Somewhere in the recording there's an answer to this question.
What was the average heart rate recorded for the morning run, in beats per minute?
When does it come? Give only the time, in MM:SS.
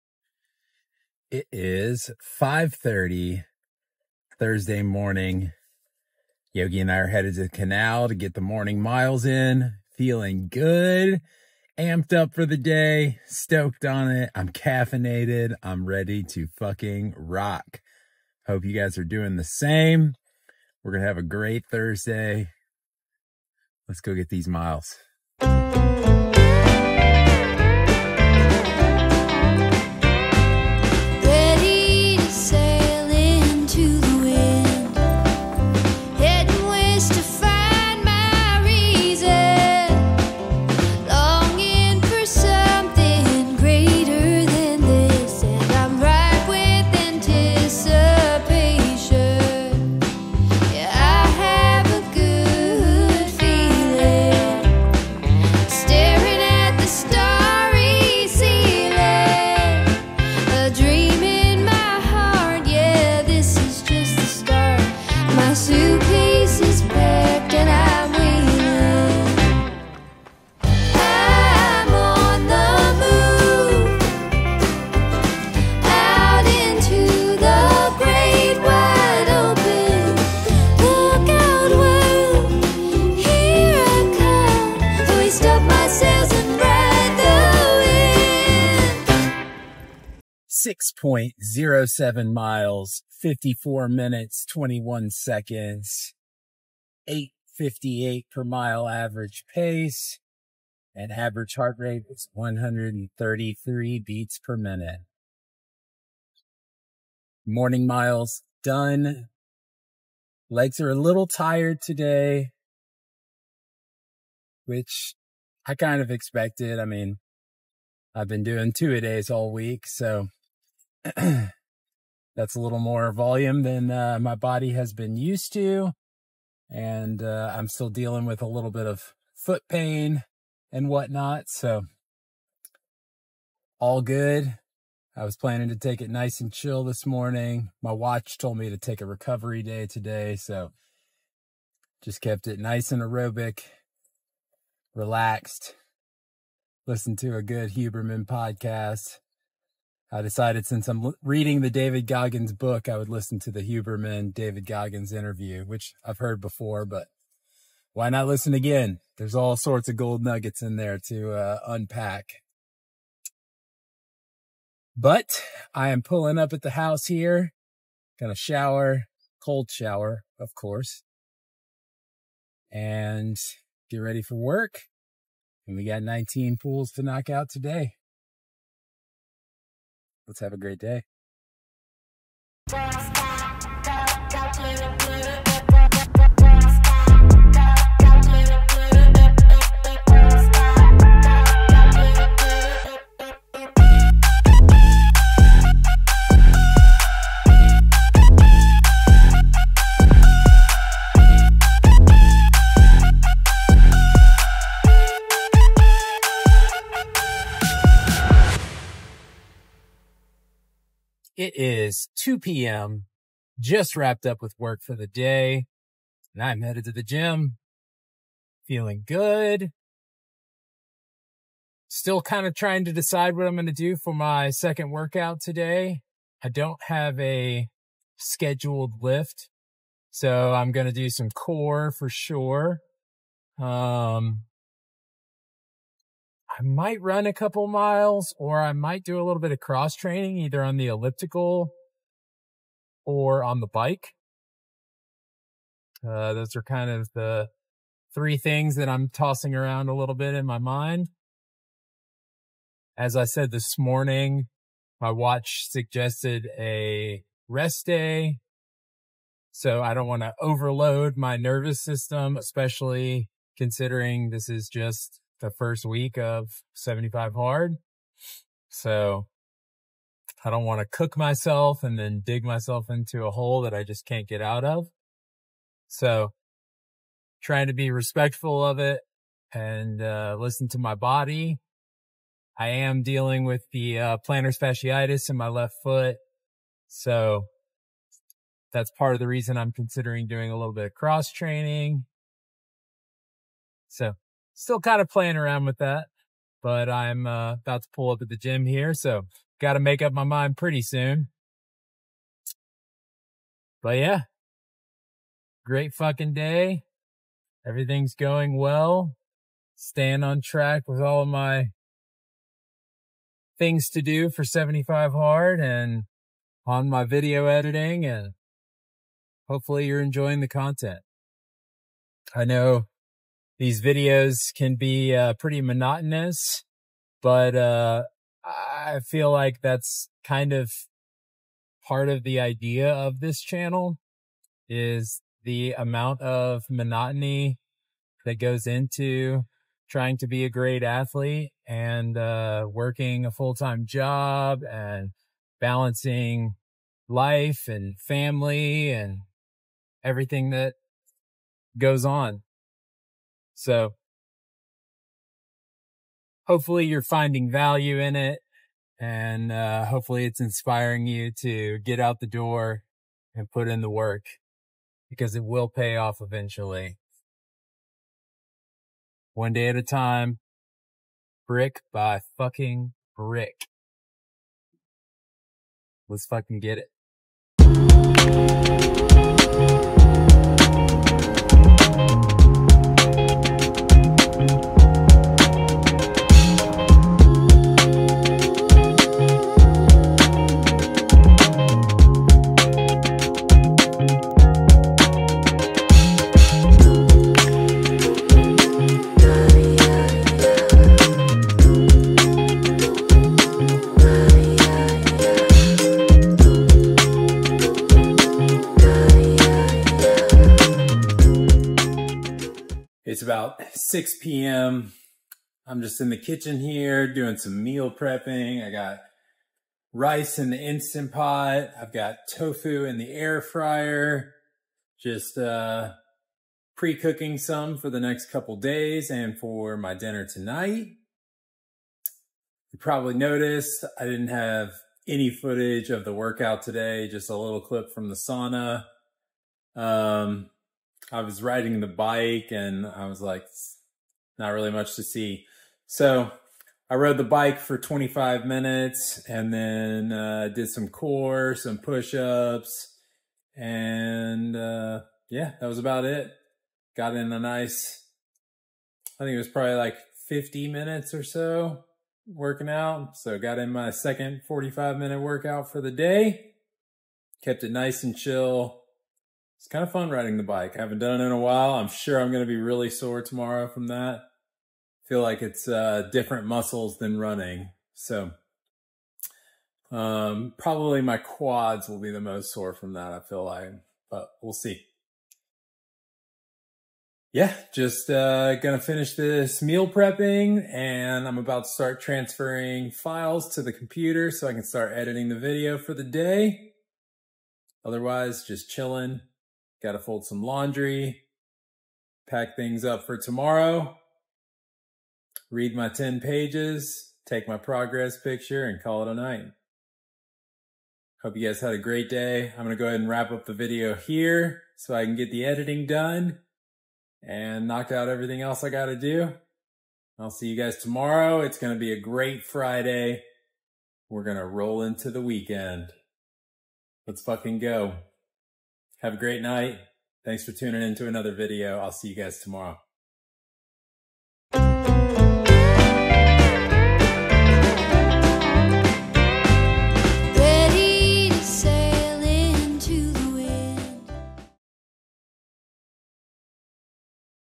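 01:42.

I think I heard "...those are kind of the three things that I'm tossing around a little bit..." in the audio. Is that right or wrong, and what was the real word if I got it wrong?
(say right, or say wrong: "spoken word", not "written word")
right.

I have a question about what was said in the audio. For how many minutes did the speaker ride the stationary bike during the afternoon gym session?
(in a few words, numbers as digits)
25.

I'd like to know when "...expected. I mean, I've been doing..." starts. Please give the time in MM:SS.
01:56.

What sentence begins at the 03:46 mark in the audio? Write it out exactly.
I don't have a scheduled lift.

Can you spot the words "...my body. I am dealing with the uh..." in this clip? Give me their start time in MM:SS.
04:40.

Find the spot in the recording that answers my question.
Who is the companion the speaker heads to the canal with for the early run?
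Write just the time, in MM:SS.
00:06.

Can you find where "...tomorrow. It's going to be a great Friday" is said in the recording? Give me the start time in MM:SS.
08:40.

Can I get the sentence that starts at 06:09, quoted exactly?
One day at a time, brick by fucking brick.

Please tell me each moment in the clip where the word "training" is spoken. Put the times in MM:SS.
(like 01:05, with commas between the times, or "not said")
03:59, 04:51.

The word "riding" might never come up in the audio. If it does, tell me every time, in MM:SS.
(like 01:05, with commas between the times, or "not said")
07:21, 07:50.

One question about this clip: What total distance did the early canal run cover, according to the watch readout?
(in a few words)
6.07 miles.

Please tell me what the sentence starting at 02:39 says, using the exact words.
There's all sorts of gold nuggets in there to uh, unpack.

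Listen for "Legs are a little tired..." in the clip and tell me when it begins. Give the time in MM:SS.
01:50.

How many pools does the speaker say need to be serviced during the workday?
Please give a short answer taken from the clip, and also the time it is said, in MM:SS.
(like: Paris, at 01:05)
19, at 02:56.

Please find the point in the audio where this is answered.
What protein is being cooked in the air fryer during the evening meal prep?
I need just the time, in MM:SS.
07:02.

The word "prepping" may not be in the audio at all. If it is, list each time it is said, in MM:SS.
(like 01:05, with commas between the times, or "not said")
06:57, 08:09.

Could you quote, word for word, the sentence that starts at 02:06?
And uh, I'm still dealing with a little bit of foot pain and whatnot.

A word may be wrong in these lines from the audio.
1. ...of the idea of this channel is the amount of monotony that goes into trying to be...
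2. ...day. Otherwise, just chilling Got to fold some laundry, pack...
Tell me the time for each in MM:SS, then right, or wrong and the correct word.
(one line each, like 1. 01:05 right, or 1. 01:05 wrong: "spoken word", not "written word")
1. 05:32 right
2. 08:16 right.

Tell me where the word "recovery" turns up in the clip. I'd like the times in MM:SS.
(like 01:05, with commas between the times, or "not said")
02:19.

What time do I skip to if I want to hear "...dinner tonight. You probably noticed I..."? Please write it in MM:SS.
07:09.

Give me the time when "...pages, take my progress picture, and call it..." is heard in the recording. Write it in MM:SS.
08:26.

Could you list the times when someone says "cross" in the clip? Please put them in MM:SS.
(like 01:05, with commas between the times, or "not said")
03:59, 04:50.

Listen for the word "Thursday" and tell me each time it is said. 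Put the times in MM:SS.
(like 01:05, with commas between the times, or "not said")
00:04, 00:21.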